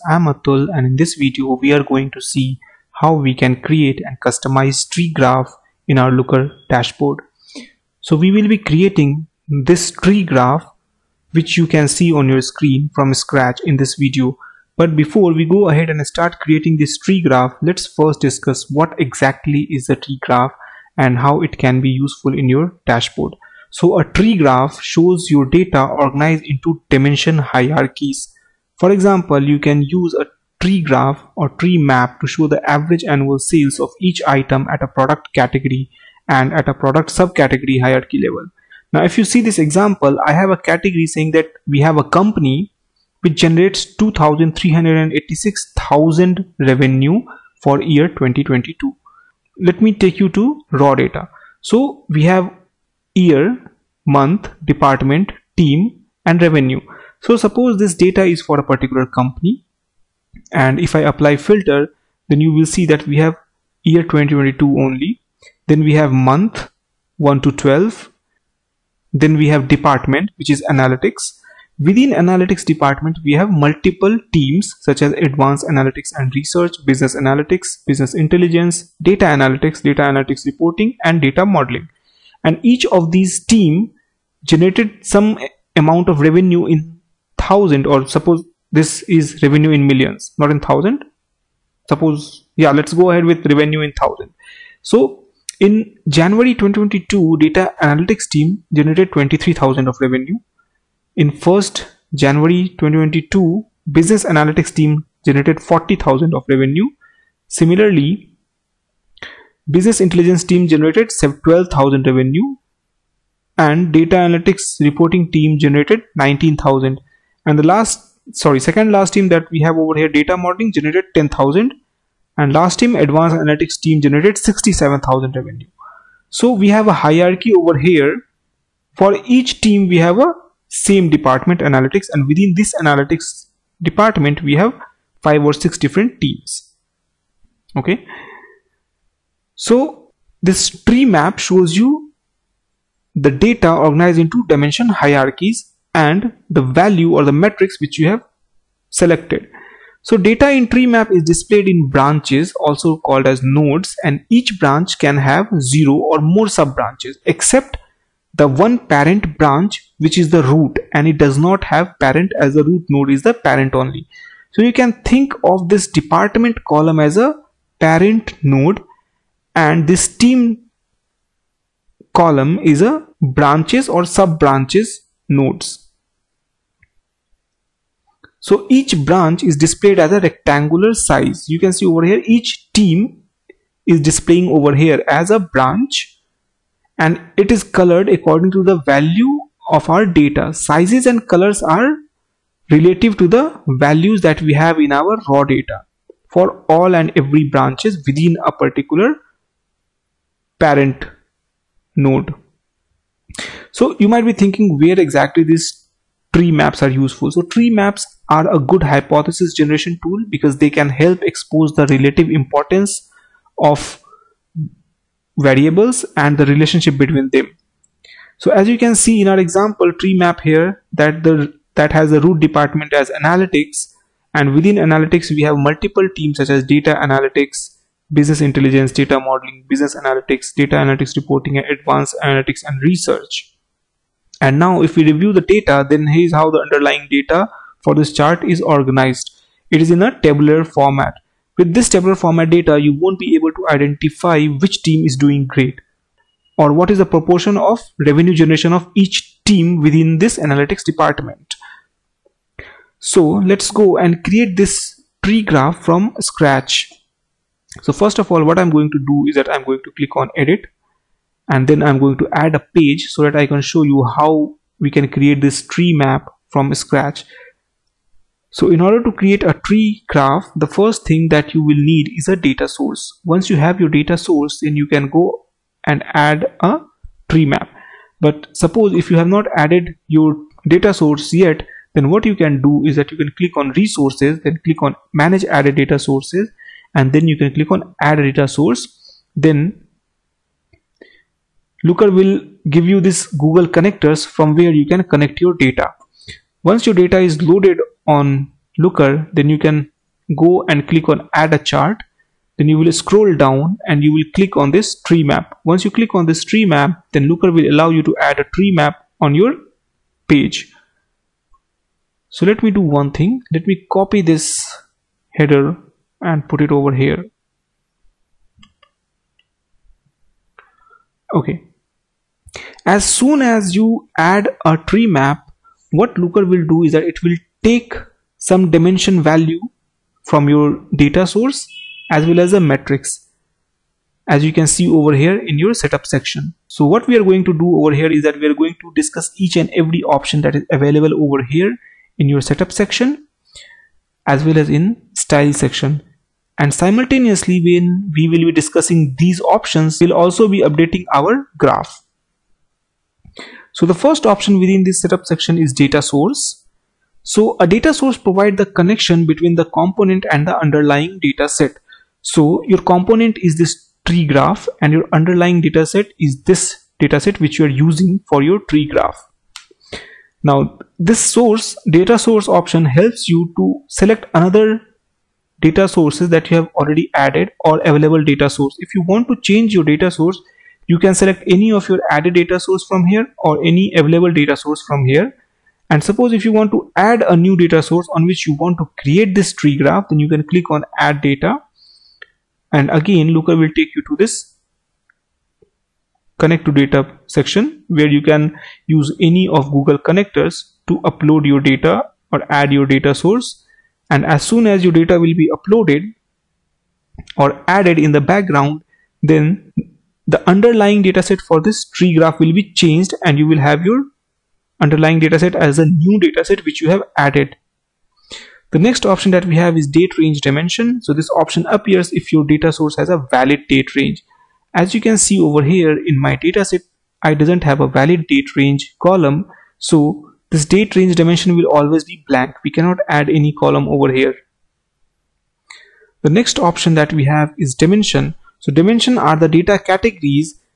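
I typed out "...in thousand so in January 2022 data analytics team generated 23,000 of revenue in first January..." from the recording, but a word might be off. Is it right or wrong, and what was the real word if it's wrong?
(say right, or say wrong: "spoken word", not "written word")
right.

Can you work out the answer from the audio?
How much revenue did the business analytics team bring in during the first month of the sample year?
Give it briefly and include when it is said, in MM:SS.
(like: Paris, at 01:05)
40,000, at 01:45.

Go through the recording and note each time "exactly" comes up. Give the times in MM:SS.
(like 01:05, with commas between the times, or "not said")
00:18, 03:24.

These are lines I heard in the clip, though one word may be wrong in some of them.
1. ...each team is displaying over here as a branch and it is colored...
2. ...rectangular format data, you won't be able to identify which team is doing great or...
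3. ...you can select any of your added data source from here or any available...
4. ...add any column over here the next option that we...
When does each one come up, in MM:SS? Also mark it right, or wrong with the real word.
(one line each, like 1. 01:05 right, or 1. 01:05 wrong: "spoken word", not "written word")
1. 03:02 right
2. 04:01 wrong: "tabular", not "rectangular"
3. 06:20 right
4. 07:13 right.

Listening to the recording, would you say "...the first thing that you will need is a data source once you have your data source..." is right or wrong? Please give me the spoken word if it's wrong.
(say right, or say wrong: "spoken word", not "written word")
right.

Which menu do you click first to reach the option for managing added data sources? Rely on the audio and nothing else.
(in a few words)
Resources.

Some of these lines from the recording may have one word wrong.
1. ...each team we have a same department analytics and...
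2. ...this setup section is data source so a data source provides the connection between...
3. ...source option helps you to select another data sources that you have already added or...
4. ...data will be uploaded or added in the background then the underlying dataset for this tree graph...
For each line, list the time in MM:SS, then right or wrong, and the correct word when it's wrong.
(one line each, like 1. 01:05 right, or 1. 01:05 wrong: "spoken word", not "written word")
1. 02:09 right
2. 05:54 right
3. 06:12 right
4. 06:44 right.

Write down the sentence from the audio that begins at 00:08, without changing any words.
So we will be creating this tree graph which you can see on your screen from scratch in this video.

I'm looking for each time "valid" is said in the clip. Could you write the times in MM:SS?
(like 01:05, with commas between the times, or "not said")
07:03, 07:07.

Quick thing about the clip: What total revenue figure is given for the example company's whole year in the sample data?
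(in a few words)
2,386,000.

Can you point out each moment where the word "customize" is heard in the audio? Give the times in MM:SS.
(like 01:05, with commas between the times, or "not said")
00:04.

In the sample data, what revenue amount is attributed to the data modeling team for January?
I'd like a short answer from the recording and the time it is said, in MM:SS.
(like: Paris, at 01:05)
10,000, at 02:01.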